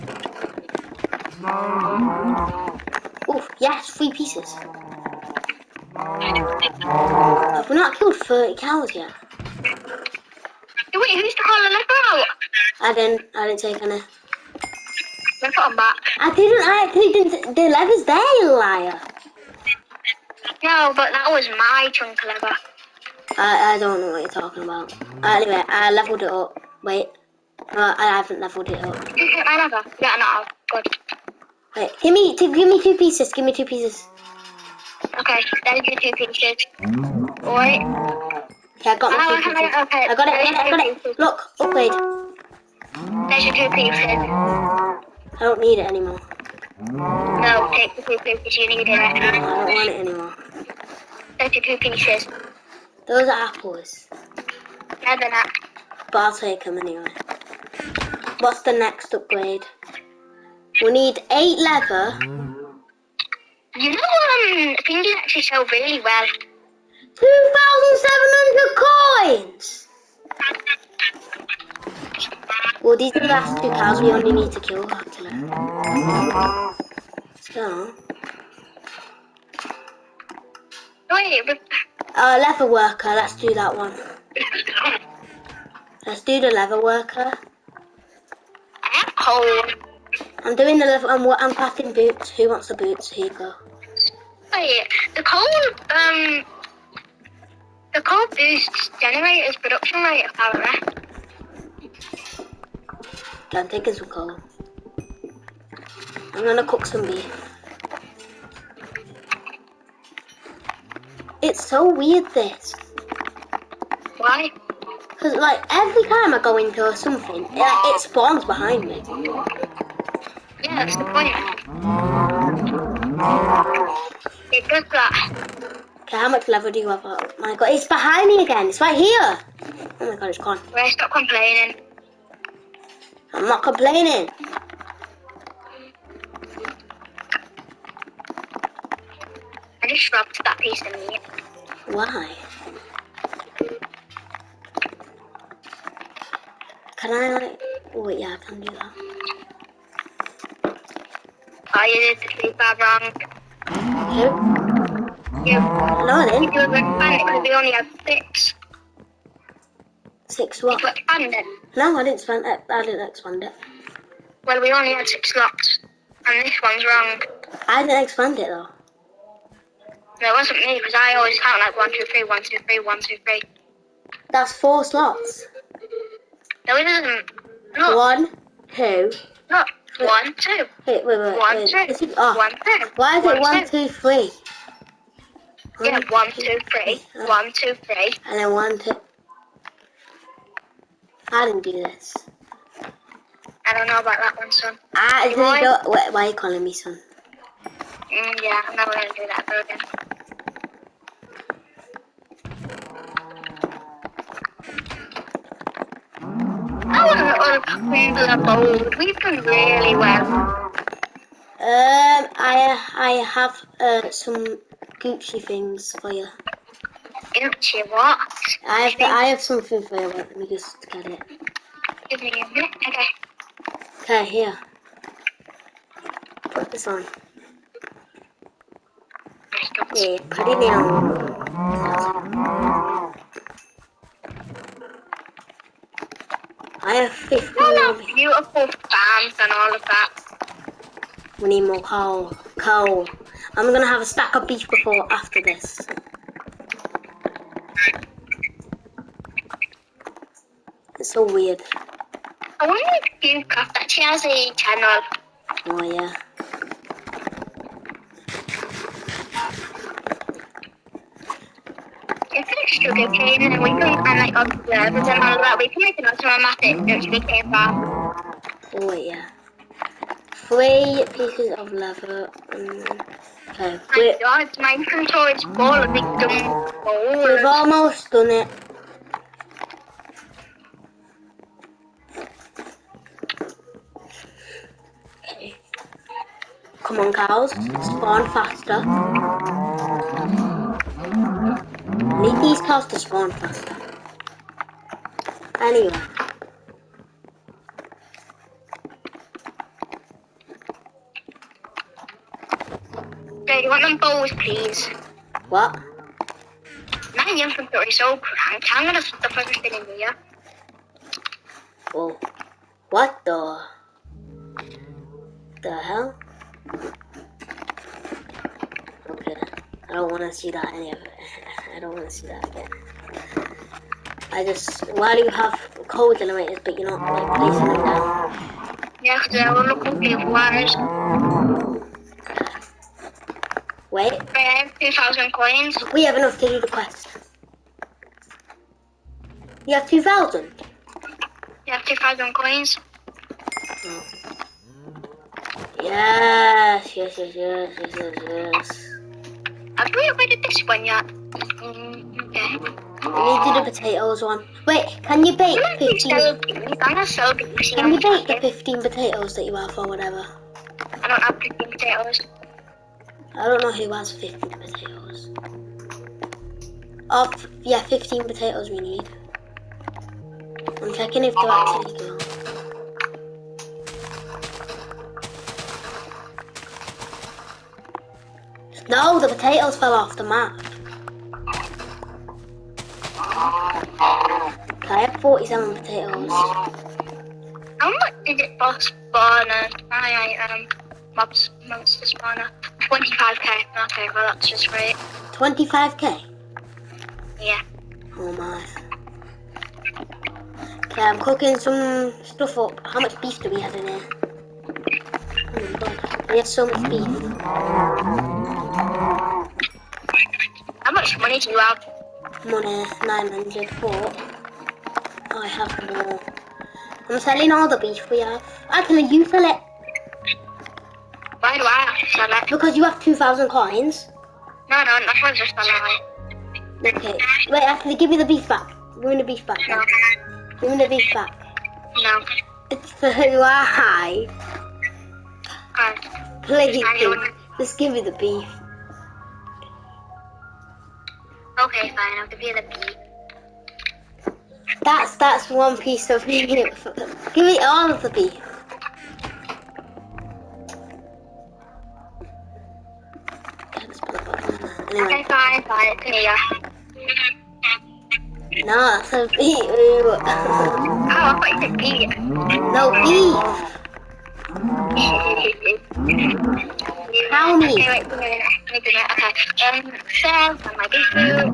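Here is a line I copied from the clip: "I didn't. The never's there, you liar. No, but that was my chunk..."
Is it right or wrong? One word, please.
wrong.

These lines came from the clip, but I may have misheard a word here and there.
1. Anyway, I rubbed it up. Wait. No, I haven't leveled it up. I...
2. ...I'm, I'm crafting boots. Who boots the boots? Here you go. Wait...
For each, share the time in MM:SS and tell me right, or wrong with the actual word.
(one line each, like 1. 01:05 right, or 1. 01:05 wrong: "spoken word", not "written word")
1. 00:25 wrong: "leveled", not "rubbed"
2. 01:31 wrong: "wants", not "boots".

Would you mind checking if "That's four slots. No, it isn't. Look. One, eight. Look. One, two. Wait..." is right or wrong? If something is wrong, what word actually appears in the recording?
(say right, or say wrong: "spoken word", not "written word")
wrong: "two", not "eight".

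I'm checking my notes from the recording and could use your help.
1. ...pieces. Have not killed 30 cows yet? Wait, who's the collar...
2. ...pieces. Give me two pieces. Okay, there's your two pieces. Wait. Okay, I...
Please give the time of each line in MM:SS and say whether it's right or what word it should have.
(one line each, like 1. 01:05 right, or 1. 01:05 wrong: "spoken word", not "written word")
1. 00:04 right
2. 00:32 right.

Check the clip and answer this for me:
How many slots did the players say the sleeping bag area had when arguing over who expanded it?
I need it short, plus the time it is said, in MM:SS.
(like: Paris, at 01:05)
6, at 02:37.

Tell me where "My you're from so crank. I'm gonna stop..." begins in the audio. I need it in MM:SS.
05:07.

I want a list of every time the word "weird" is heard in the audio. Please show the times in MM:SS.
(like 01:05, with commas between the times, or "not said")
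01:51, 04:11.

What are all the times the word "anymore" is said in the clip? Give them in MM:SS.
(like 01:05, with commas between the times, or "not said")
00:45, 00:50.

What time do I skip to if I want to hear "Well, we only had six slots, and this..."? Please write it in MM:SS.
02:44.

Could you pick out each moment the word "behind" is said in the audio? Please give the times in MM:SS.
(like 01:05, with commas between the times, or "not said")
01:58, 02:07.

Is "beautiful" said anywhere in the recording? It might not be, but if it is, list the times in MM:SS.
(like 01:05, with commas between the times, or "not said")
03:58.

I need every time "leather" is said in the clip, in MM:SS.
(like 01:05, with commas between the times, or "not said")
01:01, 01:22, 01:26, 01:30, 04:31.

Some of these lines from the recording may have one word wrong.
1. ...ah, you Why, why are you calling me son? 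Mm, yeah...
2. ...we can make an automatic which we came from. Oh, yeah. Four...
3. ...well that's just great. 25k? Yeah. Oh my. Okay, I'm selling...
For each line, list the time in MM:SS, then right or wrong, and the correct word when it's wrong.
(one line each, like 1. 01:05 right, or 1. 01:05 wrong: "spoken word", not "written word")
1. 03:14 right
2. 04:25 wrong: "Three", not "Four"
3. 06:34 wrong: "cooking", not "selling".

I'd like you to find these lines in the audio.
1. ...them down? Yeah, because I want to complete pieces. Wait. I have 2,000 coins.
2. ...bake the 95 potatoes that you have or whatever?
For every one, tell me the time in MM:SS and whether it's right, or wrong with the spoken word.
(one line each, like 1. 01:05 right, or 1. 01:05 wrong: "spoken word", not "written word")
1. 05:27 wrong: "wires", not "pieces"
2. 05:58 wrong: "15", not "95".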